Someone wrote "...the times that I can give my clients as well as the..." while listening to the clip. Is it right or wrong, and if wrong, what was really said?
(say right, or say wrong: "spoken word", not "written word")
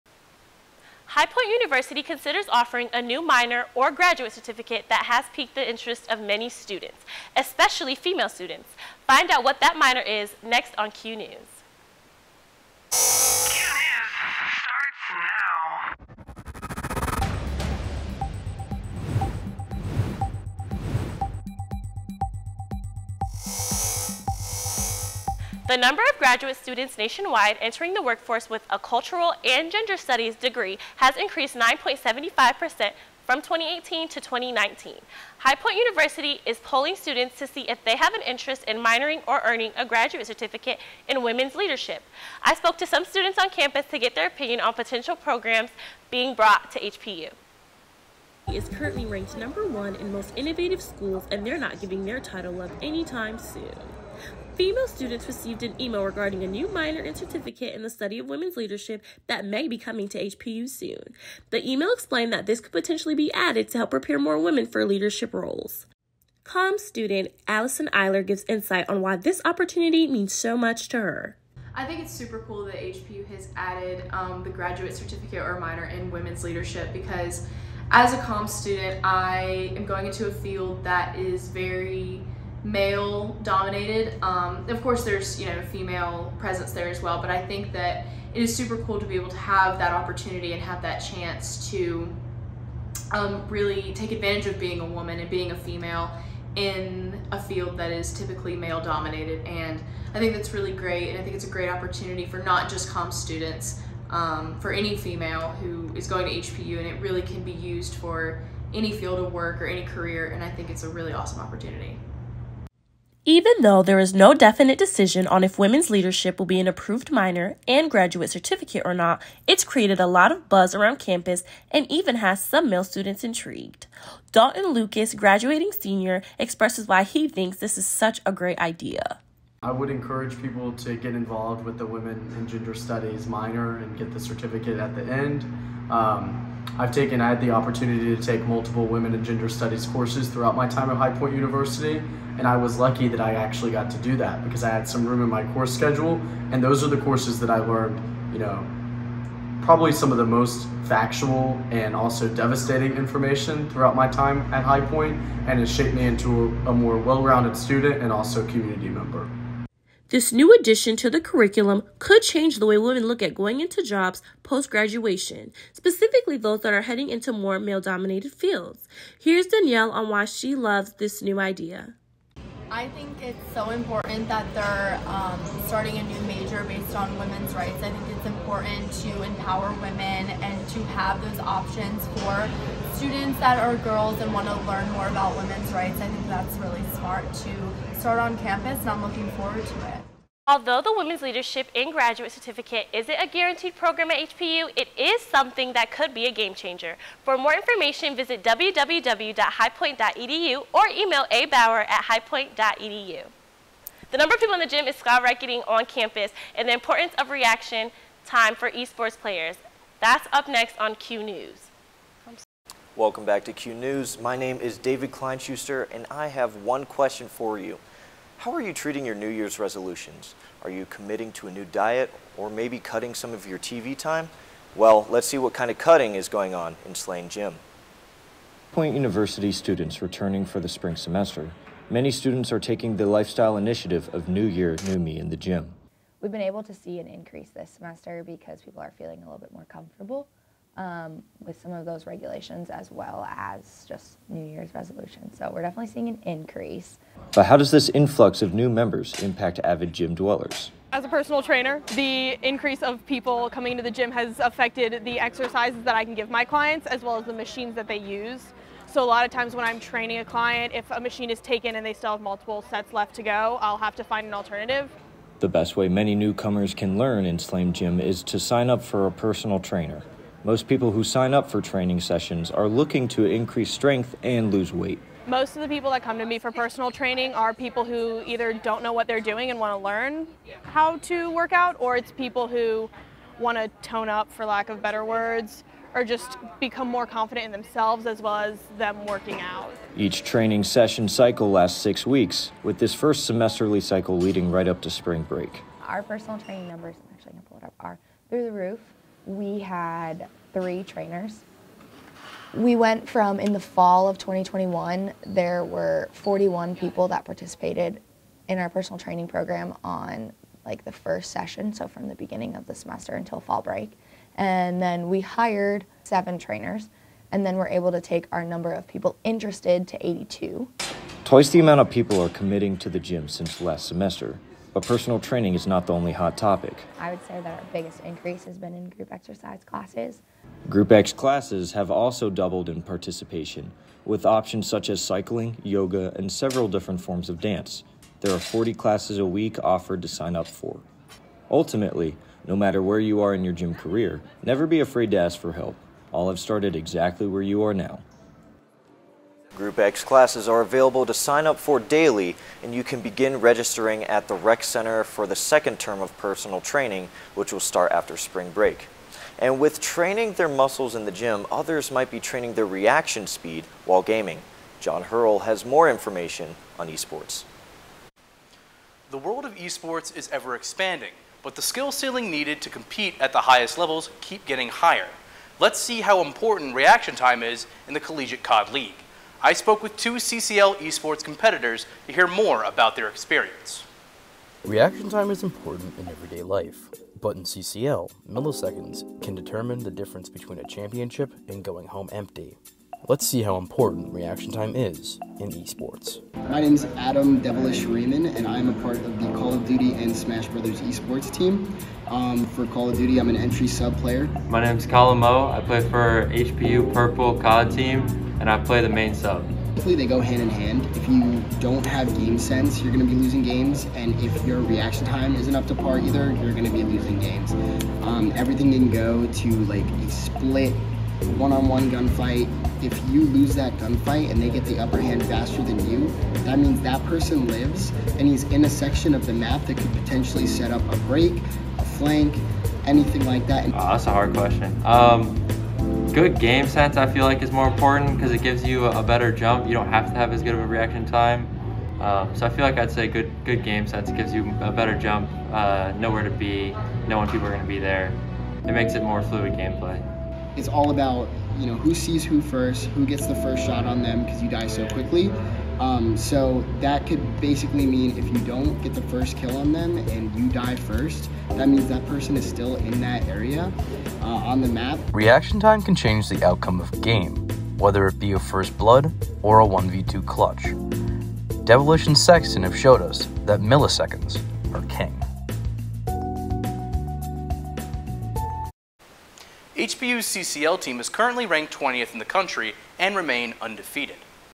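wrong: "exercises", not "times".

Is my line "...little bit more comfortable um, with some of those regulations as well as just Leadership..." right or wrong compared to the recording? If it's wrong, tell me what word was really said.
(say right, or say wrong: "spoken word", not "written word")
wrong: "New", not "Leadership".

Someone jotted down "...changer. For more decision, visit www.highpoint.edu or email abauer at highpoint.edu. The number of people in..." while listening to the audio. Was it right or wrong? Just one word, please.
wrong.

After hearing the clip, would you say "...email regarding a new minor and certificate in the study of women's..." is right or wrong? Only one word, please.
right.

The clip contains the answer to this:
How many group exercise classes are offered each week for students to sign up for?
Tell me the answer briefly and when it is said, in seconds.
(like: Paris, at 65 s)
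40, at 338 s.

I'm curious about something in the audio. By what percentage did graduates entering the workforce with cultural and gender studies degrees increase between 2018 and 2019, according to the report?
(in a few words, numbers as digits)
9.75%.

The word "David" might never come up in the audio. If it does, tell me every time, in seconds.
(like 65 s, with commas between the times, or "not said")
214 s.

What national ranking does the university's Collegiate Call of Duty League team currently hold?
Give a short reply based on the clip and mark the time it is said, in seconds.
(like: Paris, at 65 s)
20th, at 481 s.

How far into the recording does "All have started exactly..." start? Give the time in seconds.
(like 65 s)
346 s.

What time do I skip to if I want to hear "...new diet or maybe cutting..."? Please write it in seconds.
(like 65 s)
221 s.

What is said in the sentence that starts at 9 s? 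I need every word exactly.
Find out what that minor is next on Q News.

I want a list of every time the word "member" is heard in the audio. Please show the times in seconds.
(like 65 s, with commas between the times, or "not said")
158 s, 248 s.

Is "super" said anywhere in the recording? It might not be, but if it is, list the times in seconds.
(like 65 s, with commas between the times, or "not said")
72 s, 88 s.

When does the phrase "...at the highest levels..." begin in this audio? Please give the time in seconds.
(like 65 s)
373 s.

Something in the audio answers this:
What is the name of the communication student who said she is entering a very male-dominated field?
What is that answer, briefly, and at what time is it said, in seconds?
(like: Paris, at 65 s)
Allison Eiler, at 67 s.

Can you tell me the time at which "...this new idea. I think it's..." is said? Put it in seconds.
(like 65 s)
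170 s.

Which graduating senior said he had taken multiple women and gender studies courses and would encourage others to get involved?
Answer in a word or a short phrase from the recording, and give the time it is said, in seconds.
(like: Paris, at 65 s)
Dalton Lucas, at 124 s.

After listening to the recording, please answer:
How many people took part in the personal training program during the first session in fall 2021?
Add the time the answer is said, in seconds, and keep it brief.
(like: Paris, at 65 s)
41, at 306 s.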